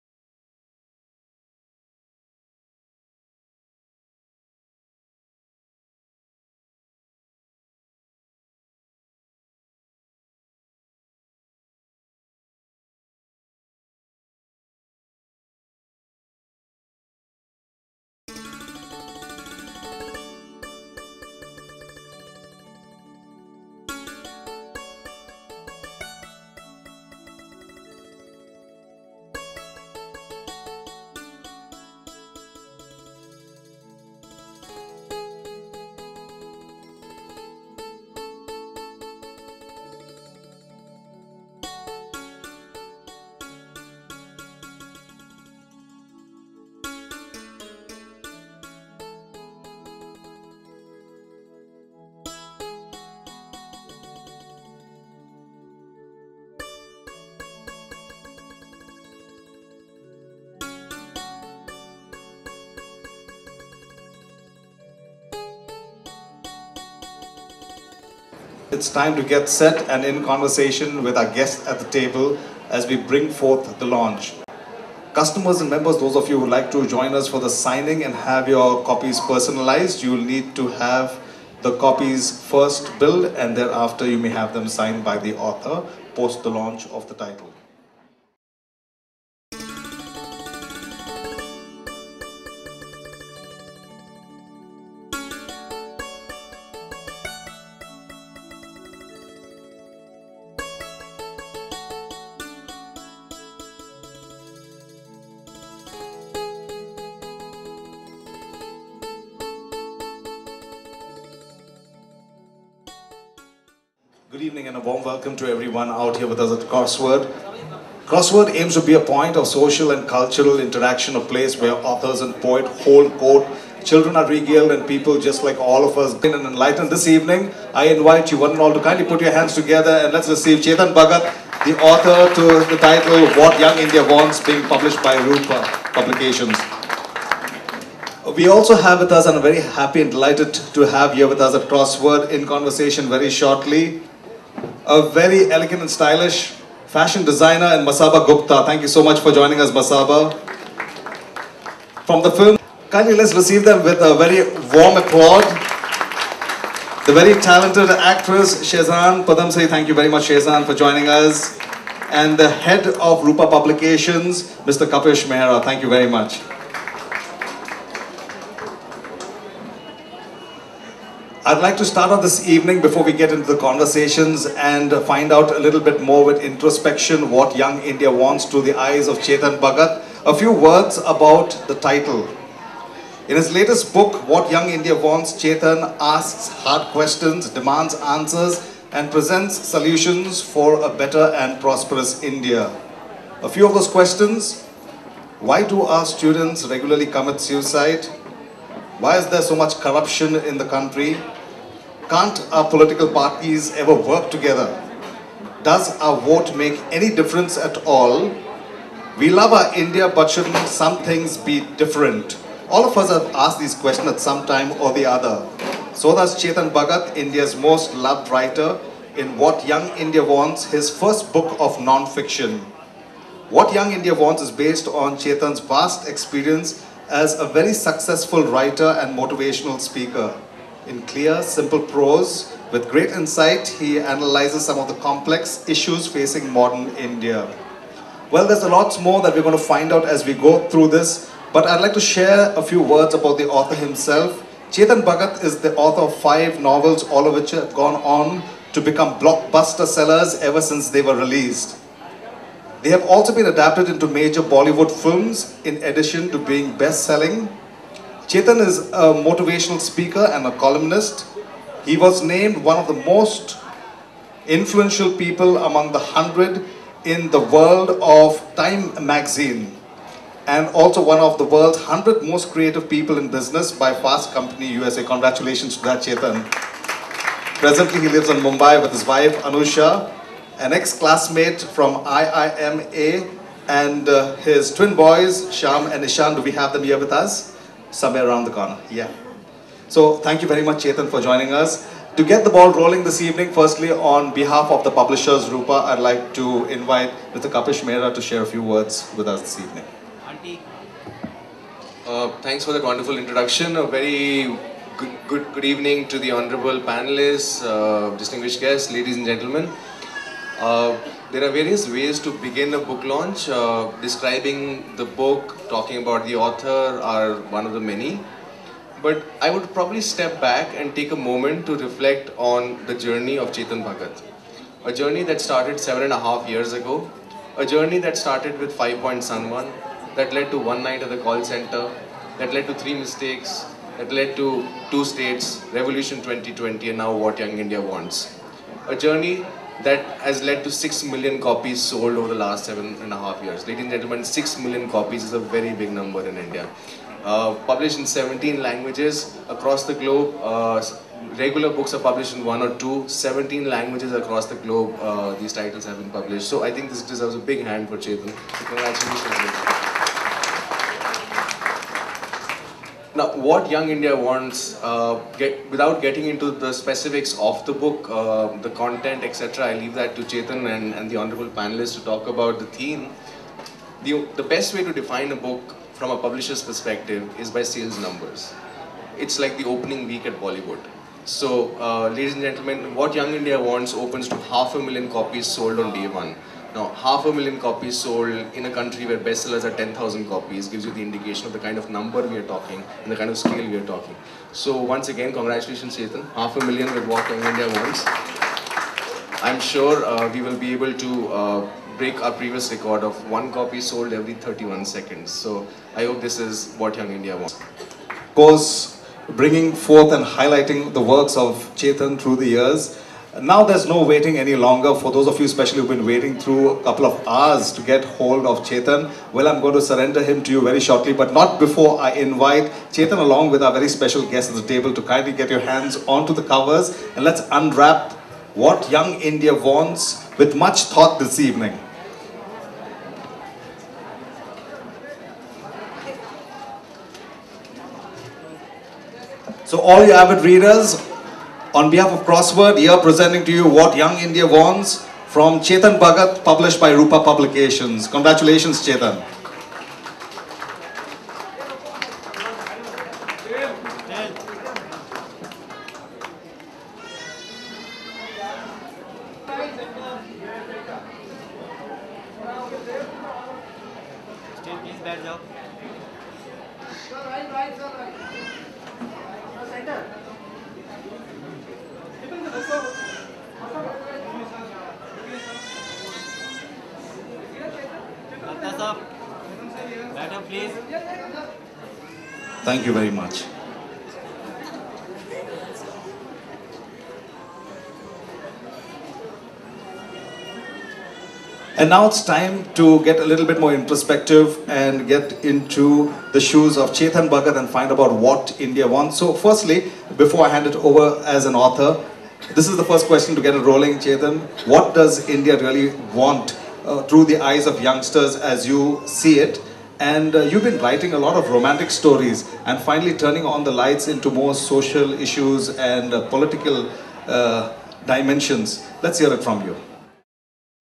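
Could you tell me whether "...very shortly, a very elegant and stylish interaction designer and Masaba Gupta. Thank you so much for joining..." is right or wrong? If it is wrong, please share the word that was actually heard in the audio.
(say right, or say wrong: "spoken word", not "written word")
wrong: "fashion", not "interaction".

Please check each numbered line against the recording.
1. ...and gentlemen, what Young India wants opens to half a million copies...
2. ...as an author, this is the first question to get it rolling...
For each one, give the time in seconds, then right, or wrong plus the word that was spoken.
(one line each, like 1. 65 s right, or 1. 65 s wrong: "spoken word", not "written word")
1. 382 s right
2. 501 s right.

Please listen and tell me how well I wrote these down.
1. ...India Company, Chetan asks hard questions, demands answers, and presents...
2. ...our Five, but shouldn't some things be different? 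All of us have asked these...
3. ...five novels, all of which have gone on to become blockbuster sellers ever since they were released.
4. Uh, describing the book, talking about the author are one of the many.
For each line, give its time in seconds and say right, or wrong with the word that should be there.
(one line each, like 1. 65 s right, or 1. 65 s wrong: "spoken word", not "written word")
1. 184 s wrong: "Wants", not "Company"
2. 209 s wrong: "India", not "Five"
3. 246 s right
4. 313 s right.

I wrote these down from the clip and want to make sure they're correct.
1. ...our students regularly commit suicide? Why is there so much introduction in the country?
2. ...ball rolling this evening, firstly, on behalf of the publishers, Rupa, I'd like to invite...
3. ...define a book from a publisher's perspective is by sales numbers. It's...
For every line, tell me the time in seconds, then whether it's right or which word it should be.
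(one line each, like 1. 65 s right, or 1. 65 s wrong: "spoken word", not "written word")
1. 195 s wrong: "corruption", not "introduction"
2. 292 s right
3. 374 s right.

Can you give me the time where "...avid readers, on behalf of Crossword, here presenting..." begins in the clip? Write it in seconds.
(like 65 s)
440 s.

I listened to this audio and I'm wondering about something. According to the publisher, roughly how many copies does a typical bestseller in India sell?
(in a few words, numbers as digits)
10,000.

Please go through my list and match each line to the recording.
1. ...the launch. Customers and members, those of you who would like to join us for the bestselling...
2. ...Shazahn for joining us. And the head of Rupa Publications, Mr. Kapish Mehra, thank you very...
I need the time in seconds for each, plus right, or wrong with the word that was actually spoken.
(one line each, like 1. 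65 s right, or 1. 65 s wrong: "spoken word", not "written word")
1. 73 s wrong: "signing", not "bestselling"
2. 160 s right.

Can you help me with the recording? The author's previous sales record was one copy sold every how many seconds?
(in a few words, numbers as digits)
31 seconds.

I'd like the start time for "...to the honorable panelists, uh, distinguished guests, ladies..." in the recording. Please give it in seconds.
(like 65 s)
306 s.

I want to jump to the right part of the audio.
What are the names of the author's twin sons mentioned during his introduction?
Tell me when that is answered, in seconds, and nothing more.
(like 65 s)
285 s.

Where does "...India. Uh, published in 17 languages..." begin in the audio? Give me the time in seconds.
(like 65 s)
346 s.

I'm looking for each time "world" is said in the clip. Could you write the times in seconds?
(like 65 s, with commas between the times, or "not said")
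267 s, 271 s.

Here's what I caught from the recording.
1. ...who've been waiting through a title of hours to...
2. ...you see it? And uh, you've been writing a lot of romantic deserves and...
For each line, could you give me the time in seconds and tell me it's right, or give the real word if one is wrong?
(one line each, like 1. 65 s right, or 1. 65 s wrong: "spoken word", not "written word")
1. 415 s wrong: "couple", not "title"
2. 508 s wrong: "stories", not "deserves".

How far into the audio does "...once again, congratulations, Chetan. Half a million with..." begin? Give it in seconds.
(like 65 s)
394 s.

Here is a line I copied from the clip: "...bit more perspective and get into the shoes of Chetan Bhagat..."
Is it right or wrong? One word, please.
wrong.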